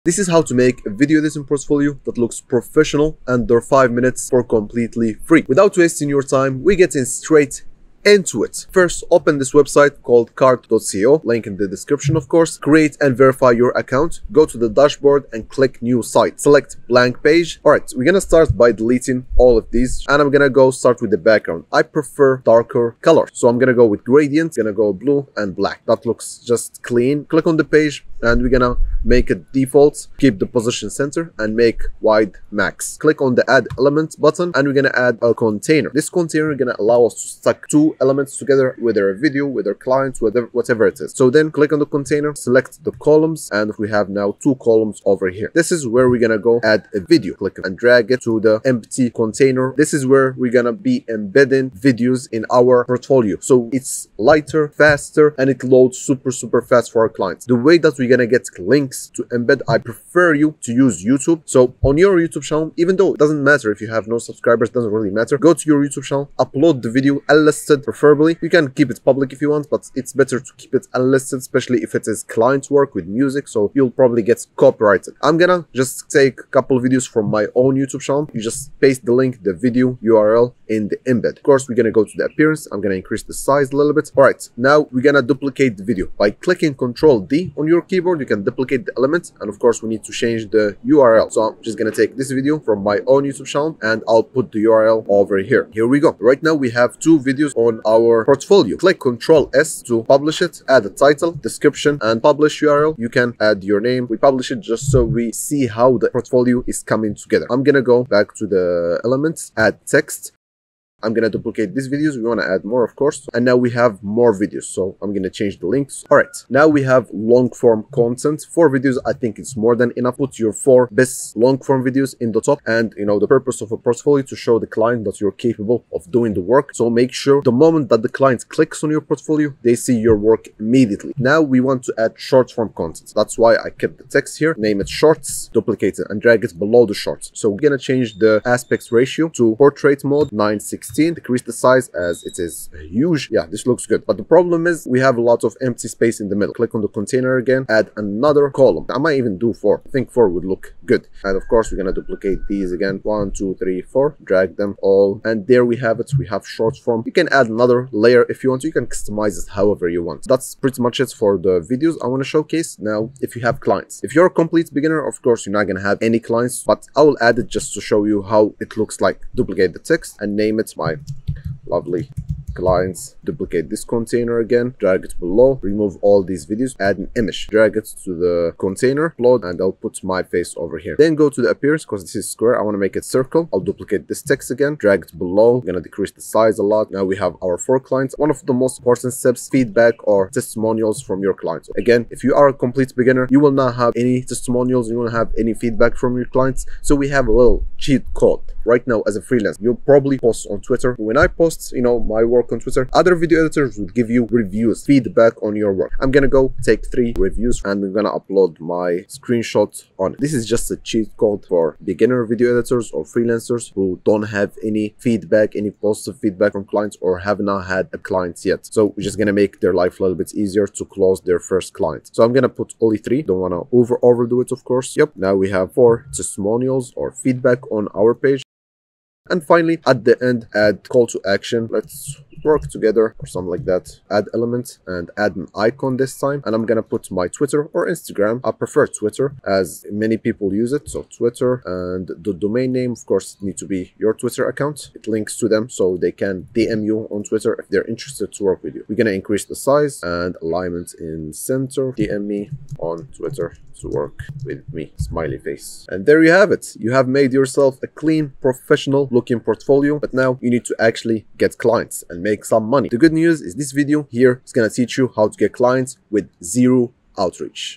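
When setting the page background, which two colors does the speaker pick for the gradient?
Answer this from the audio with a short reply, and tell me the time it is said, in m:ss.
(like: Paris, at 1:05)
blue and black, at 0:24.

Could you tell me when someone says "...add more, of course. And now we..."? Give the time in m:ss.
1:52.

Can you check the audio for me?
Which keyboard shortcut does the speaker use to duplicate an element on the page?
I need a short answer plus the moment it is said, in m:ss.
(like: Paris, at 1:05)
Control D, at 1:26.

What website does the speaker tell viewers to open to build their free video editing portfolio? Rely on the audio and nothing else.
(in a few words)
carrd.co.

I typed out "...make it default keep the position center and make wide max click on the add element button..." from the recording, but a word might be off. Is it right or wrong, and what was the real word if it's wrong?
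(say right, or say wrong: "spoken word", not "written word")
right.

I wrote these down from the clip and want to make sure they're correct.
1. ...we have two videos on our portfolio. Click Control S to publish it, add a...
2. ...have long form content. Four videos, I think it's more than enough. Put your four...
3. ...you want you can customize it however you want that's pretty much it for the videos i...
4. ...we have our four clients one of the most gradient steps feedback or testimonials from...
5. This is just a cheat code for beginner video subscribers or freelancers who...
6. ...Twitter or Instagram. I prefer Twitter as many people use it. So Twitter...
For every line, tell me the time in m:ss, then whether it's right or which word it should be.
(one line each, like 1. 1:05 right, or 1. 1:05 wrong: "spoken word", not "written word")
1. 1:36 right
2. 1:56 right
3. 2:38 right
4. 3:07 wrong: "important", not "gradient"
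5. 3:30 wrong: "editors", not "subscribers"
6. 3:57 right.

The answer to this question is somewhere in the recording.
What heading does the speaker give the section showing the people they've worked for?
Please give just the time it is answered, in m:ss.
2:50.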